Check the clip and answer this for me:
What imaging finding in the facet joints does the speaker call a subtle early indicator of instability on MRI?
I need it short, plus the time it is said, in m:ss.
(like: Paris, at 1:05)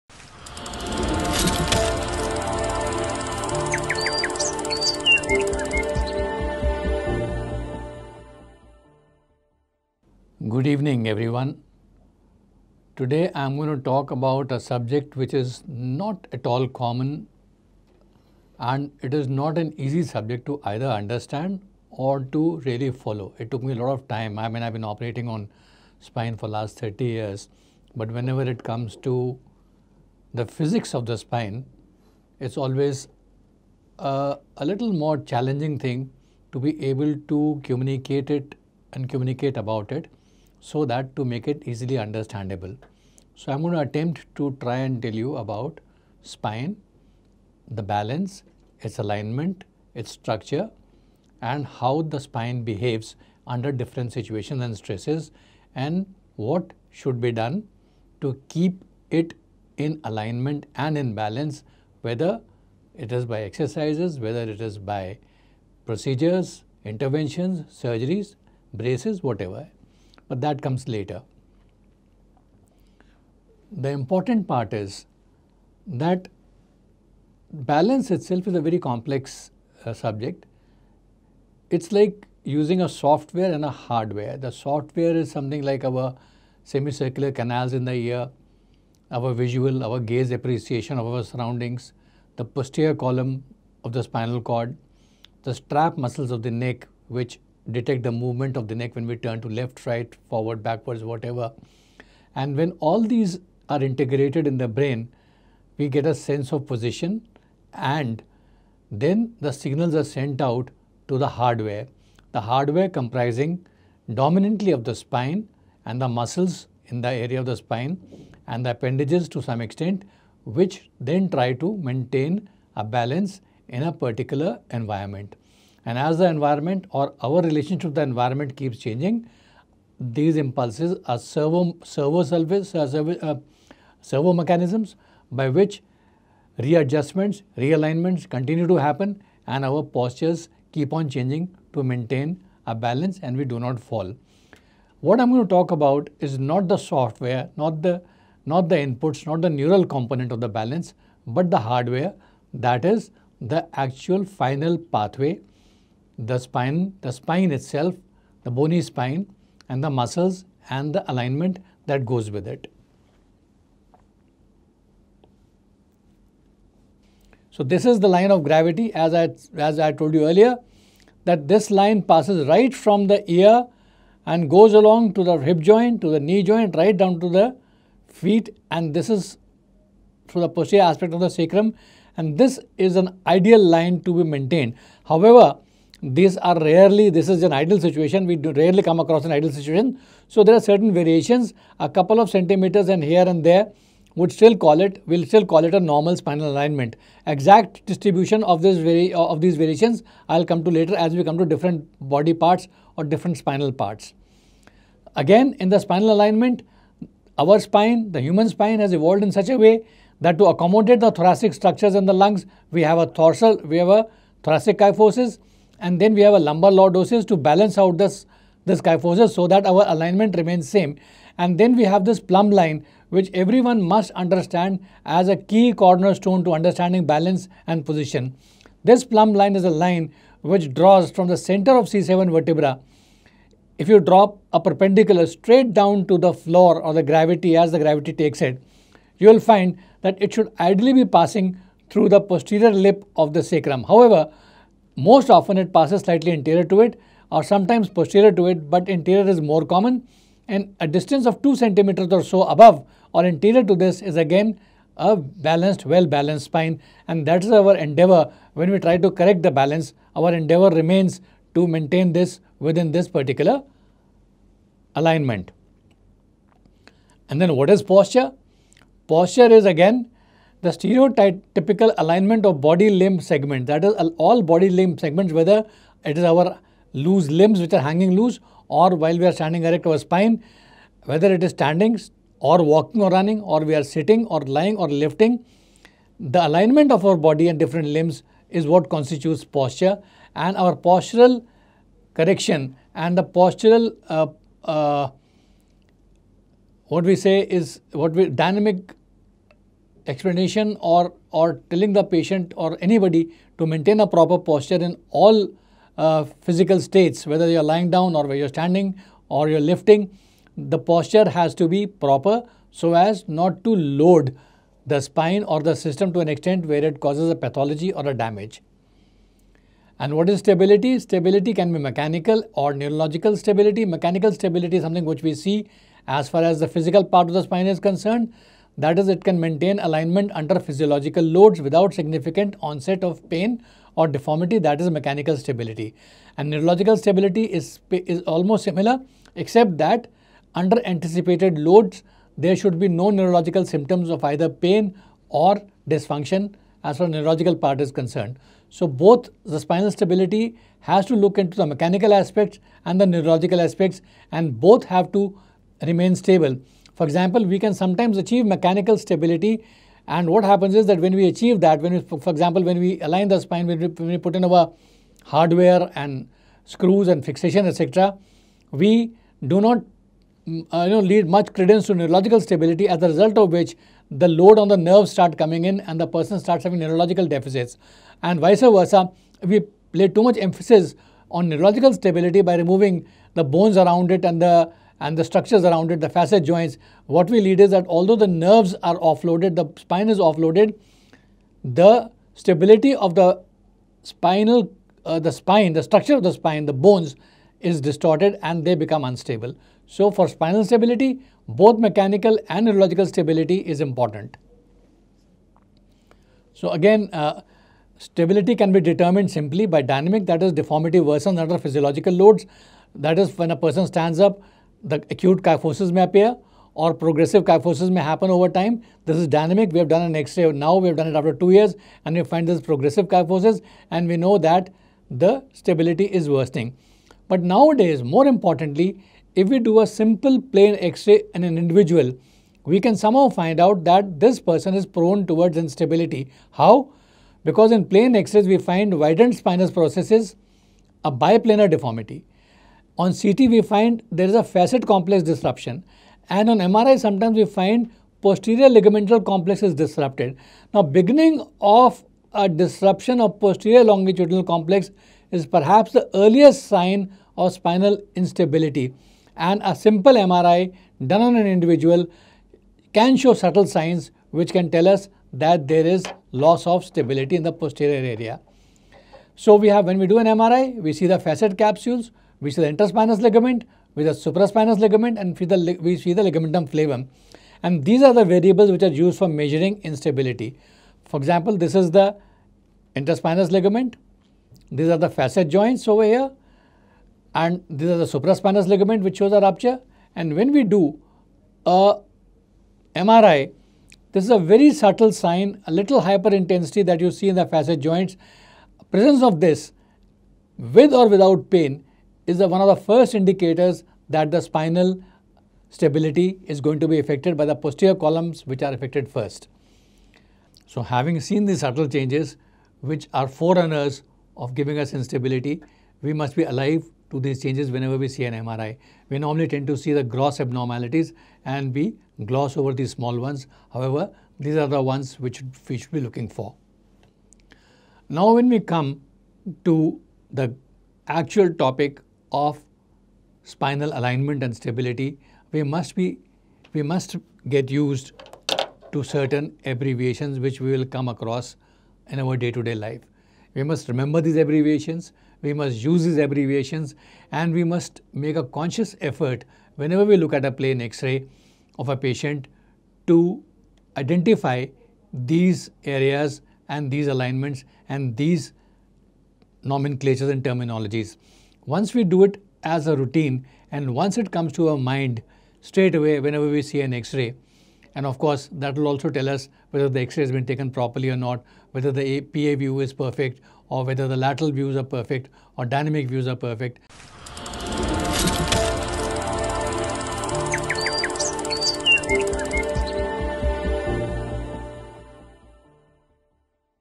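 hyperintensity, at 8:16.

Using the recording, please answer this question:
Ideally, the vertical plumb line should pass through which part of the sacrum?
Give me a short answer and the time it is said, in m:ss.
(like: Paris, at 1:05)
posterior lip, at 4:02.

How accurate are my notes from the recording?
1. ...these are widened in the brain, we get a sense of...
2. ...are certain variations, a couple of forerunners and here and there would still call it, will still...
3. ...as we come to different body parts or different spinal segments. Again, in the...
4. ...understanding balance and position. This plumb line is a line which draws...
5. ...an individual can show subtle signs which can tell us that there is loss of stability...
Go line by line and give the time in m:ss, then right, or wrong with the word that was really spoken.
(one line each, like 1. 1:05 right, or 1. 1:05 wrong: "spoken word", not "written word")
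1. 1:43 wrong: "integrated", not "widened"
2. 3:10 wrong: "centimeters", not "forerunners"
3. 3:20 wrong: "parts", not "segments"
4. 3:46 right
5. 7:41 right.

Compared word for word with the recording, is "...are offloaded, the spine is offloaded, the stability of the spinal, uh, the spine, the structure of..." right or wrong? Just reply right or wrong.
right.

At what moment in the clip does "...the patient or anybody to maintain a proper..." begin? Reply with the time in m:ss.
5:01.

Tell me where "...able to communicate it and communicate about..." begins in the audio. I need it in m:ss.
0:36.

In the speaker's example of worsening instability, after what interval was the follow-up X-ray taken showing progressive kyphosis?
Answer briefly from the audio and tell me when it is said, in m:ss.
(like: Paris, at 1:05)
two years, at 7:01.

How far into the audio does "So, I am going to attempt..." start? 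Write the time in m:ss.
0:43.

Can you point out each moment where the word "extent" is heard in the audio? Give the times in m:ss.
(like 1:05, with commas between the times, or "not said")
1:59, 5:16.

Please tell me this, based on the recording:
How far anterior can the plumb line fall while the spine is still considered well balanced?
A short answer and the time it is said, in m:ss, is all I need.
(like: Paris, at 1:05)
2 centimeters, at 4:11.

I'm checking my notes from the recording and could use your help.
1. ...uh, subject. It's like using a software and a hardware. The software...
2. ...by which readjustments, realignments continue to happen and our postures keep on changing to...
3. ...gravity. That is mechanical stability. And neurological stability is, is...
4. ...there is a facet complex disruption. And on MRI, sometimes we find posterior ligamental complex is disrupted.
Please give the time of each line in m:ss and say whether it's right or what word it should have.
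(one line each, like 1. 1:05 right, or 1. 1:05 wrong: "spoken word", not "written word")
1. 1:19 right
2. 2:15 right
3. 5:34 wrong: "deformity", not "gravity"
4. 7:24 right.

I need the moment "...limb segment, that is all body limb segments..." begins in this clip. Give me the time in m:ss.
4:32.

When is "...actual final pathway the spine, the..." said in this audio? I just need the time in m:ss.
2:33.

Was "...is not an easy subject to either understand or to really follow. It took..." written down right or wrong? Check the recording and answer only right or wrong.
right.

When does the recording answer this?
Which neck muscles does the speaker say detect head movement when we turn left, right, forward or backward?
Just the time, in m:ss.
1:35.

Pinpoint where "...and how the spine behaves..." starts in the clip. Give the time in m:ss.
0:51.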